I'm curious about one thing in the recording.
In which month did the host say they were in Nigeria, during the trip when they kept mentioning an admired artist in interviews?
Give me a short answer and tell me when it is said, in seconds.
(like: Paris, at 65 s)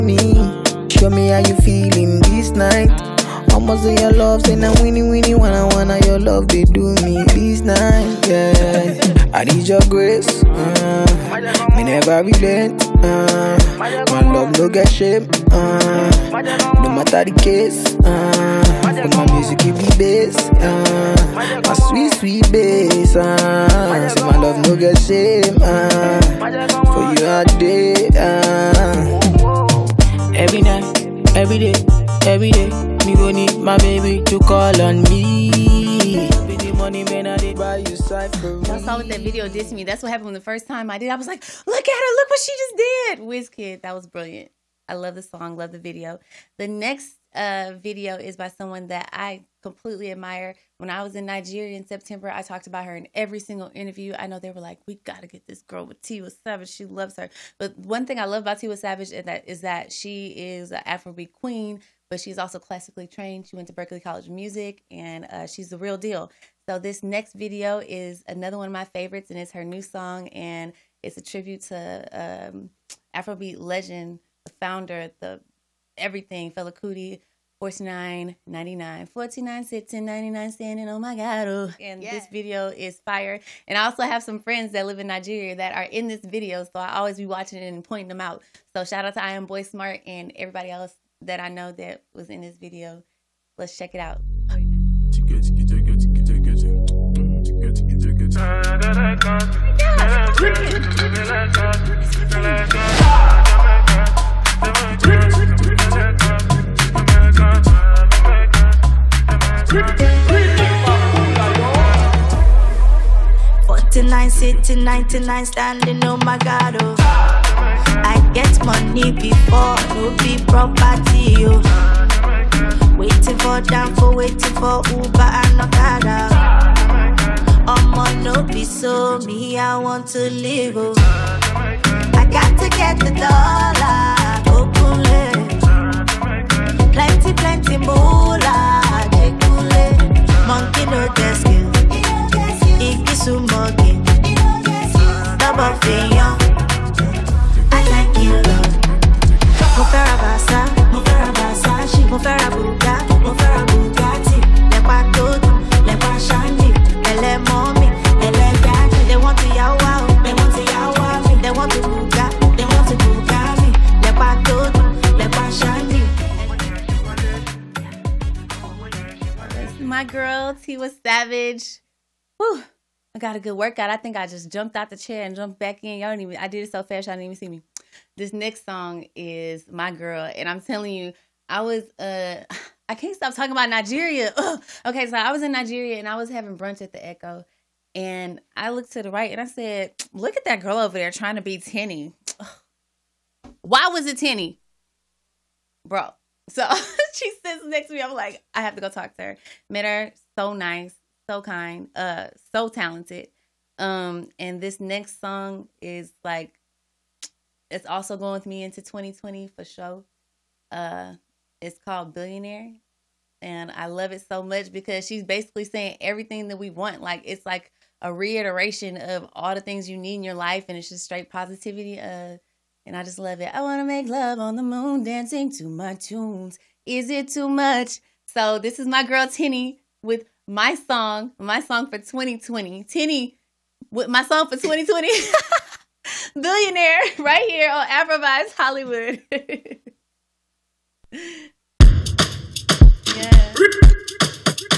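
September, at 51 s.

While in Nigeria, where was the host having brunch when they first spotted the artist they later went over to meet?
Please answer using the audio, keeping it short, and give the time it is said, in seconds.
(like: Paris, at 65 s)
the Echo, at 186 s.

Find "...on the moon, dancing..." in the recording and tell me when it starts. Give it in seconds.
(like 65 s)
224 s.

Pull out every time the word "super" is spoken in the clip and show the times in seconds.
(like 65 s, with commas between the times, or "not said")
not said.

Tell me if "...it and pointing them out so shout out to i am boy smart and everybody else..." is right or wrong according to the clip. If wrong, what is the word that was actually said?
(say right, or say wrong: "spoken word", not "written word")
right.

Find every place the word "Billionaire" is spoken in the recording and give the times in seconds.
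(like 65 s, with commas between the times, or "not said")
212 s, 236 s.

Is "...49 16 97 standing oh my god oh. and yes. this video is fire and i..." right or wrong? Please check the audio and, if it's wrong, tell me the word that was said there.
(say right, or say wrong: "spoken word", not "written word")
wrong: "99", not "97".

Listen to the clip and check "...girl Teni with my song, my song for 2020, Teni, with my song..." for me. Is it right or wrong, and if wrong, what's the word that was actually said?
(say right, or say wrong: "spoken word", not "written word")
right.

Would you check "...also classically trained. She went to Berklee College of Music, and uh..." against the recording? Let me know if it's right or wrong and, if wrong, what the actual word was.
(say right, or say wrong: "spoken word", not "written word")
right.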